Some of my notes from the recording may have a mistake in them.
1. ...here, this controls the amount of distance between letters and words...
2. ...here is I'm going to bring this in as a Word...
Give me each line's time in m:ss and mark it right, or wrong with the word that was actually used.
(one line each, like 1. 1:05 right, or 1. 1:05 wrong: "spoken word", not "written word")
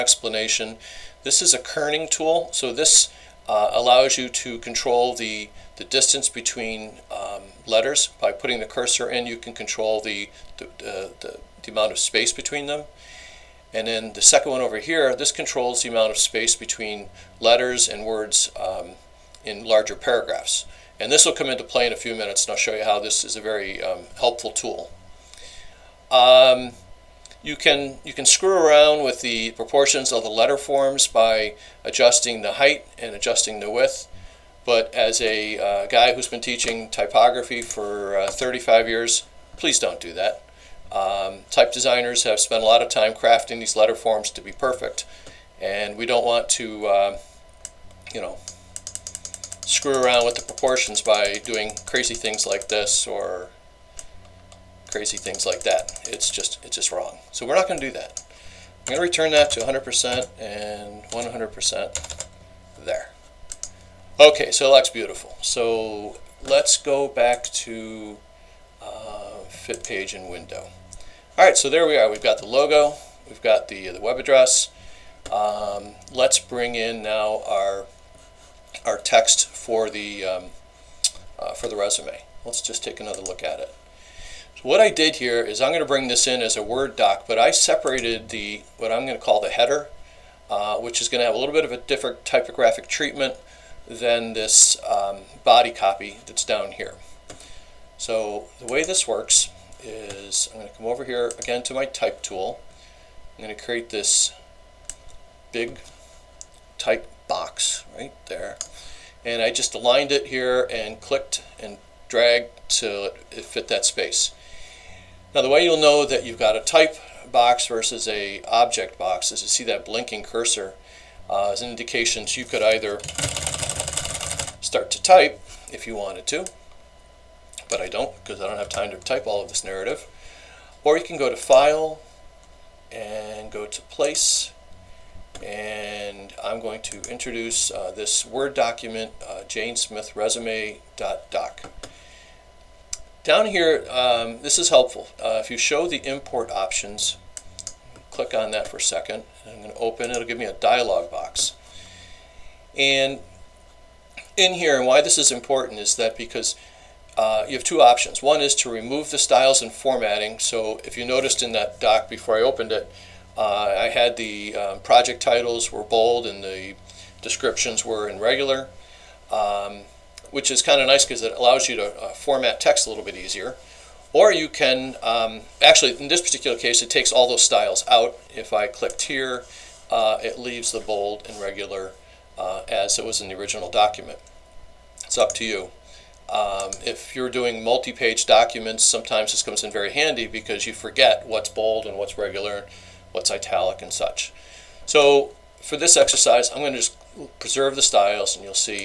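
1. 0:14 wrong: "space", not "distance"
2. 1:25 right.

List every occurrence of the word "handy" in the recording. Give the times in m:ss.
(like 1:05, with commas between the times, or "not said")
3:09.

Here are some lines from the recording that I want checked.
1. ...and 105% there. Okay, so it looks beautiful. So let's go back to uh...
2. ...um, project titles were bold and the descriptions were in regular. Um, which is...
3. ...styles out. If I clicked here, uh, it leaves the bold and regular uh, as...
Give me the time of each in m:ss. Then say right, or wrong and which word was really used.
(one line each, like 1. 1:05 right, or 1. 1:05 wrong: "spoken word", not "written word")
1. 1:00 wrong: "100", not "105"
2. 2:44 right
3. 2:57 right.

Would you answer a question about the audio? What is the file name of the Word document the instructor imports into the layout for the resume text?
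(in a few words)
janesmithresume.doc.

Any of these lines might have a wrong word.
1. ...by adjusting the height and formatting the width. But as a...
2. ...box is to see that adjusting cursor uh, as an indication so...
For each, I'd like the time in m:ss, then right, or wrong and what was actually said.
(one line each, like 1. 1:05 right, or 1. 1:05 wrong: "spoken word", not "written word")
1. 0:31 wrong: "adjusting", not "formatting"
2. 1:58 wrong: "blinking", not "adjusting".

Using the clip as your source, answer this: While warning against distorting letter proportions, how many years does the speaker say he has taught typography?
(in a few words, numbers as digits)
35.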